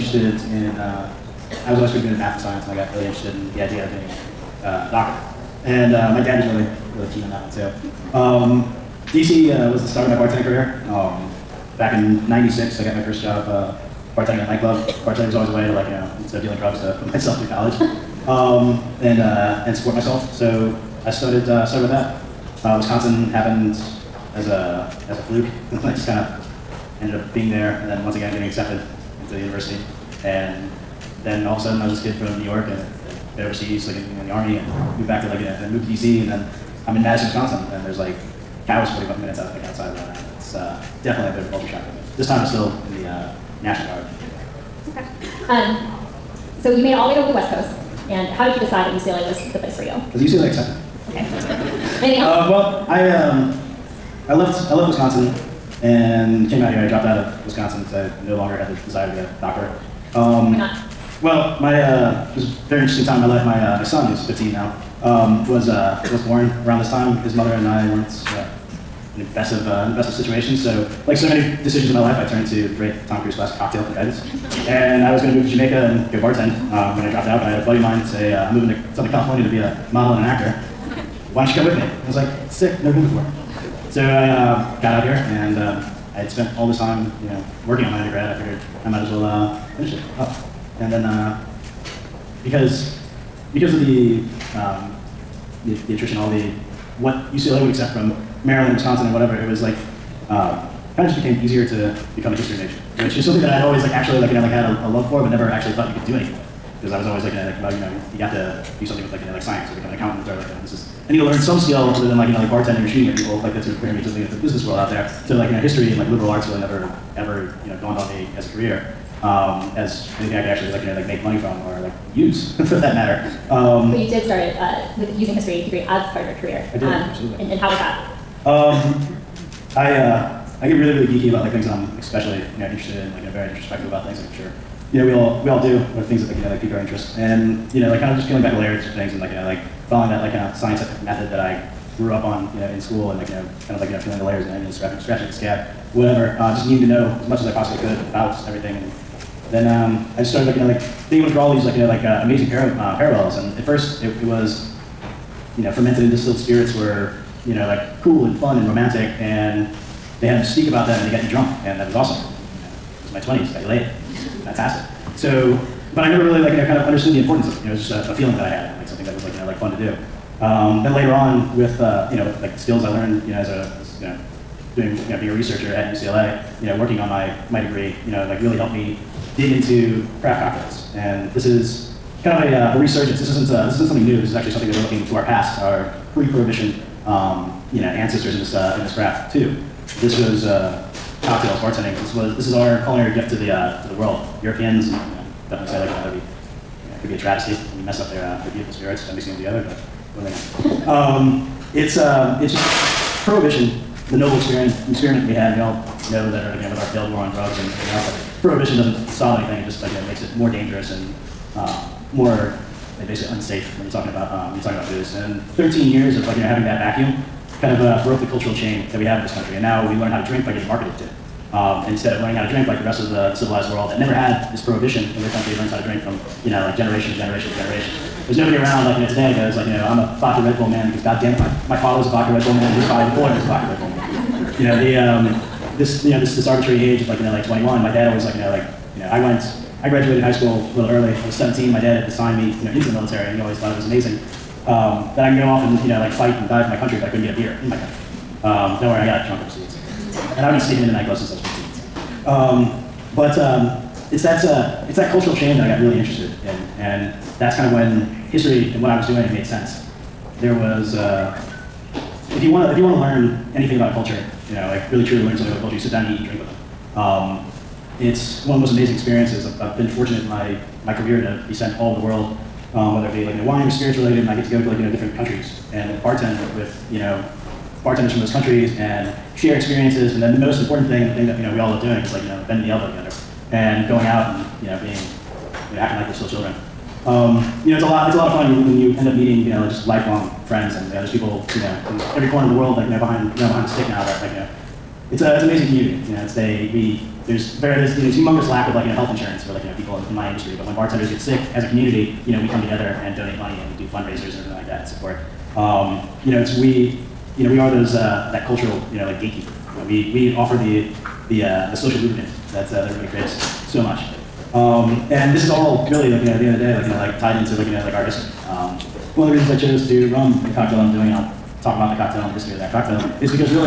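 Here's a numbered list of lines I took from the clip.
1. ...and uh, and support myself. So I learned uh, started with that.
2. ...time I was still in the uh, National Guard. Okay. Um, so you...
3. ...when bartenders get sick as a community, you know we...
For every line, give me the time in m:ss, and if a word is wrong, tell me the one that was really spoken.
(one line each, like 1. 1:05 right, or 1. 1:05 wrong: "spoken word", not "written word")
1. 0:19 wrong: "started", not "learned"
2. 0:42 right
3. 5:00 right.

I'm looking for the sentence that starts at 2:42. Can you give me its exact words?
It was my twenties, got you laid, fantastic.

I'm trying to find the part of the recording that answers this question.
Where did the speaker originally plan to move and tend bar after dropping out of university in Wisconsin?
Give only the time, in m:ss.
1:15.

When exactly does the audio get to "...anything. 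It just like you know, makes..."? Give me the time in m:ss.
3:29.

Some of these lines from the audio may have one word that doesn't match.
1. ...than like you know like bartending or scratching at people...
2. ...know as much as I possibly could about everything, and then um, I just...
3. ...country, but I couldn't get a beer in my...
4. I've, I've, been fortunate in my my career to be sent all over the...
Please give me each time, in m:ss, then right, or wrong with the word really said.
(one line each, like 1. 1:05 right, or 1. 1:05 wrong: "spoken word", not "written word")
1. 1:52 wrong: "shooting", not "scratching"
2. 2:26 right
3. 4:06 right
4. 4:29 right.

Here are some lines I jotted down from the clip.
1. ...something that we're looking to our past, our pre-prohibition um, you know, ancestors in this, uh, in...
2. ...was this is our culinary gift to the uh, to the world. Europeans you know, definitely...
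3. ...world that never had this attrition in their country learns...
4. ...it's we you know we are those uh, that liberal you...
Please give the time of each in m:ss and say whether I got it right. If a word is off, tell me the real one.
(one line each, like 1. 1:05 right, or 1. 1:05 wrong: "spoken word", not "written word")
1. 3:04 right
2. 3:12 right
3. 3:43 wrong: "prohibition", not "attrition"
4. 5:06 wrong: "cultural", not "liberal".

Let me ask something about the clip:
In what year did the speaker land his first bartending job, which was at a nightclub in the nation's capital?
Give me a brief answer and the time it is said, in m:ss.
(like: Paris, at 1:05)
1996, at 0:12.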